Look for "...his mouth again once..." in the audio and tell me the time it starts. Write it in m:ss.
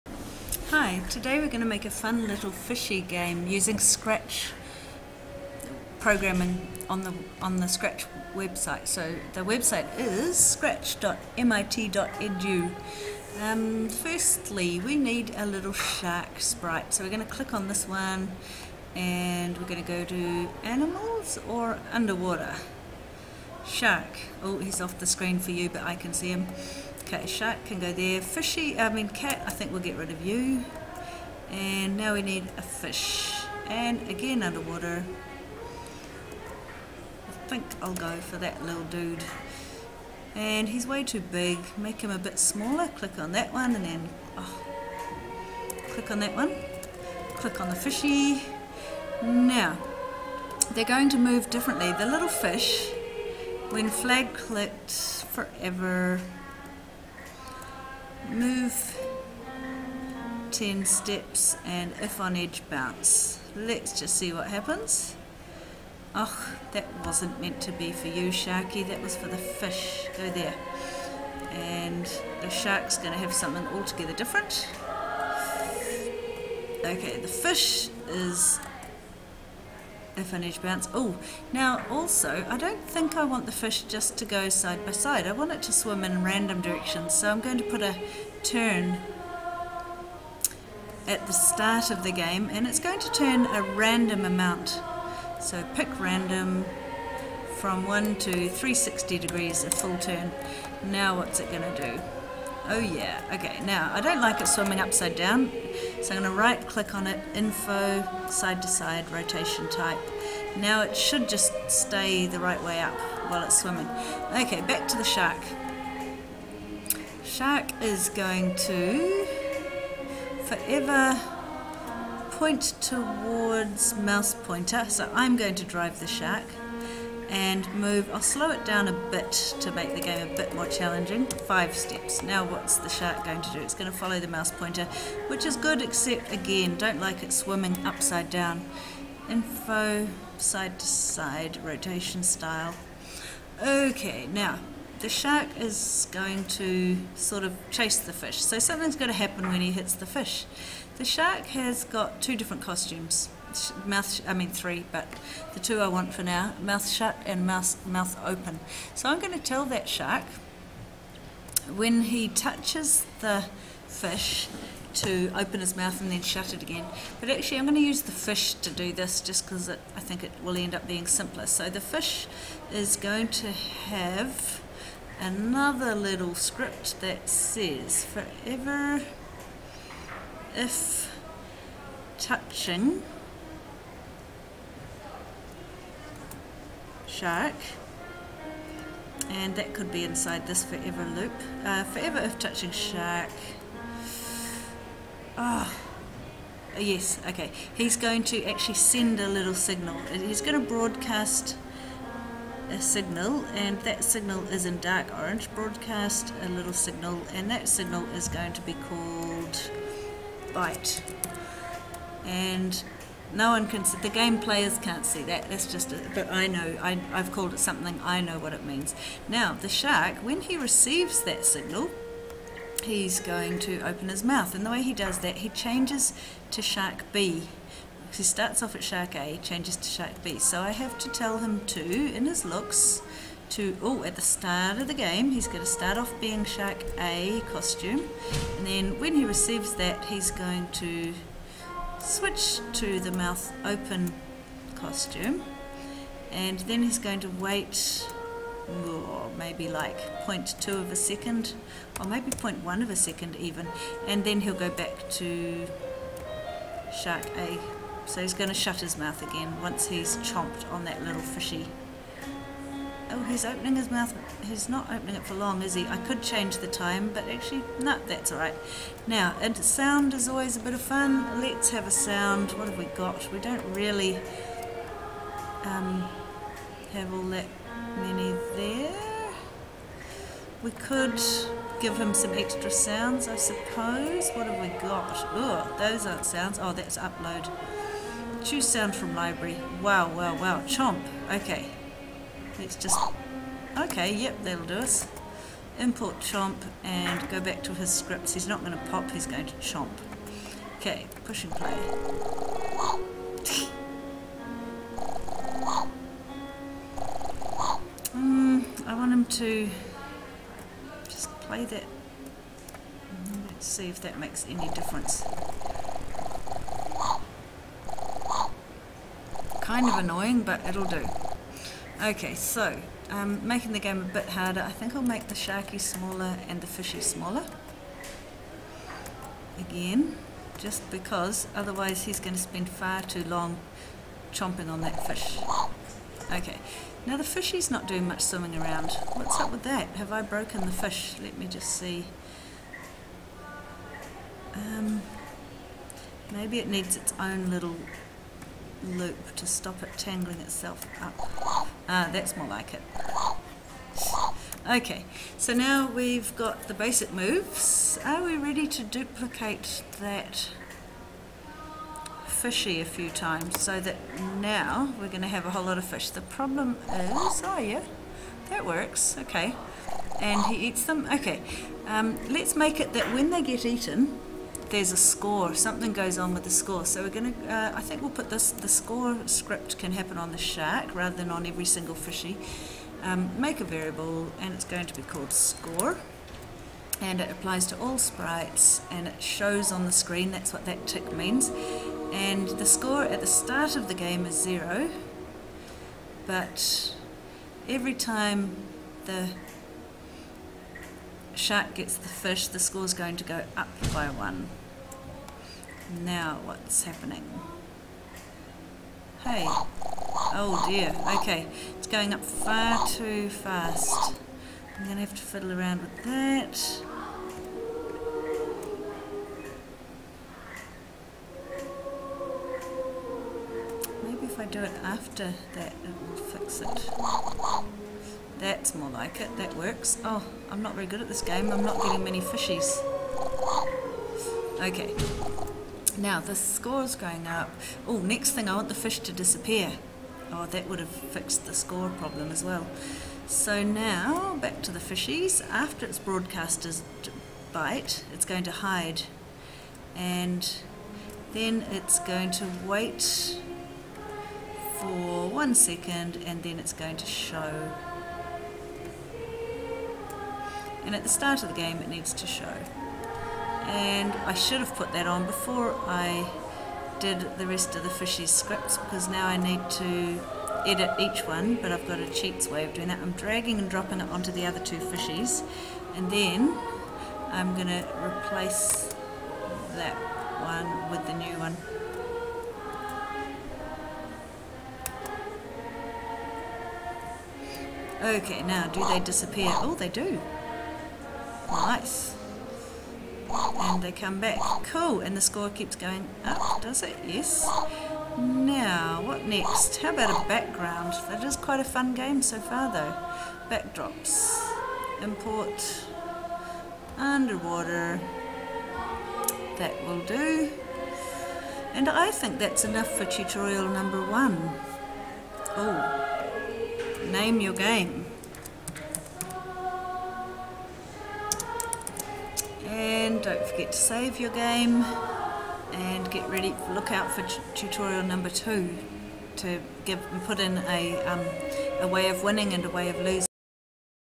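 4:18.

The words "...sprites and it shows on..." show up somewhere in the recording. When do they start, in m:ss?
6:27.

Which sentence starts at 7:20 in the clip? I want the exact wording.
Oh, that would have fixed the score problem as well.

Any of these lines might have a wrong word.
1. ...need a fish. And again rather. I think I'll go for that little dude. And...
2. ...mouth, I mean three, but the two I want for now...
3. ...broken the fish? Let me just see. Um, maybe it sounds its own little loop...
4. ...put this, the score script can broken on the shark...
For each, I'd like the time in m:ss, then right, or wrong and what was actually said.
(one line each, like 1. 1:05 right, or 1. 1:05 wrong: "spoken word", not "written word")
1. 0:32 wrong: "underwater", not "rather"
2. 2:33 right
3. 5:40 wrong: "needs", not "sounds"
4. 6:18 wrong: "happen", not "broken".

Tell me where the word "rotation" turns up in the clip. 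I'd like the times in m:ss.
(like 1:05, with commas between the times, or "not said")
1:49, 2:21.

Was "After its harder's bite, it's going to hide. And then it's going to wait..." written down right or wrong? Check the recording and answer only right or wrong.
wrong.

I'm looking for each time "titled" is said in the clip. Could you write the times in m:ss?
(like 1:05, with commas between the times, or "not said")
not said.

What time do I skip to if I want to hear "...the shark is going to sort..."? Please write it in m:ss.
2:24.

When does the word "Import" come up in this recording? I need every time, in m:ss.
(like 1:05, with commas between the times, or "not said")
4:55, 8:25.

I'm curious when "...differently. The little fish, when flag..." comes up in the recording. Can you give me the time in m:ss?
0:51.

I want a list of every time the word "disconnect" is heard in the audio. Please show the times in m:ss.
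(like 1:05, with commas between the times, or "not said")
not said.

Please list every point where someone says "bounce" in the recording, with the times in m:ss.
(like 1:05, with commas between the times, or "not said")
1:02, 1:20.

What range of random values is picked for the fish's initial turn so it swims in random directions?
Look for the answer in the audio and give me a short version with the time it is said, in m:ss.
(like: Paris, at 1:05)
1 to 360, at 1:35.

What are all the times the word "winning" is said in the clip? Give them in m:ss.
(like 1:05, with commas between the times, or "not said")
8:52.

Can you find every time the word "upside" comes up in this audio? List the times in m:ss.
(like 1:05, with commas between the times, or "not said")
1:44, 2:17.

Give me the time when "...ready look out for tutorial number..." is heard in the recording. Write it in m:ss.
8:46.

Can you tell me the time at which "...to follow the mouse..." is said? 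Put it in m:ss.
2:13.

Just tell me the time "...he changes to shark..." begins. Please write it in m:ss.
3:45.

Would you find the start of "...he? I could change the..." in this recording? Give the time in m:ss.
4:25.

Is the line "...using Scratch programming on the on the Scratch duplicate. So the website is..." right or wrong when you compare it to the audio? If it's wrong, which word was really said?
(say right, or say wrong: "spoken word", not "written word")
wrong: "website", not "duplicate".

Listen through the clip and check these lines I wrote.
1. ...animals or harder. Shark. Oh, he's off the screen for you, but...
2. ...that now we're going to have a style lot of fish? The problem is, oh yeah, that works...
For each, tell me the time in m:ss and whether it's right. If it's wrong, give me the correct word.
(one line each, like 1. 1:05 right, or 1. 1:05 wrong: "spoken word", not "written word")
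1. 0:20 wrong: "underwater", not "harder"
2. 6:03 wrong: "whole", not "style".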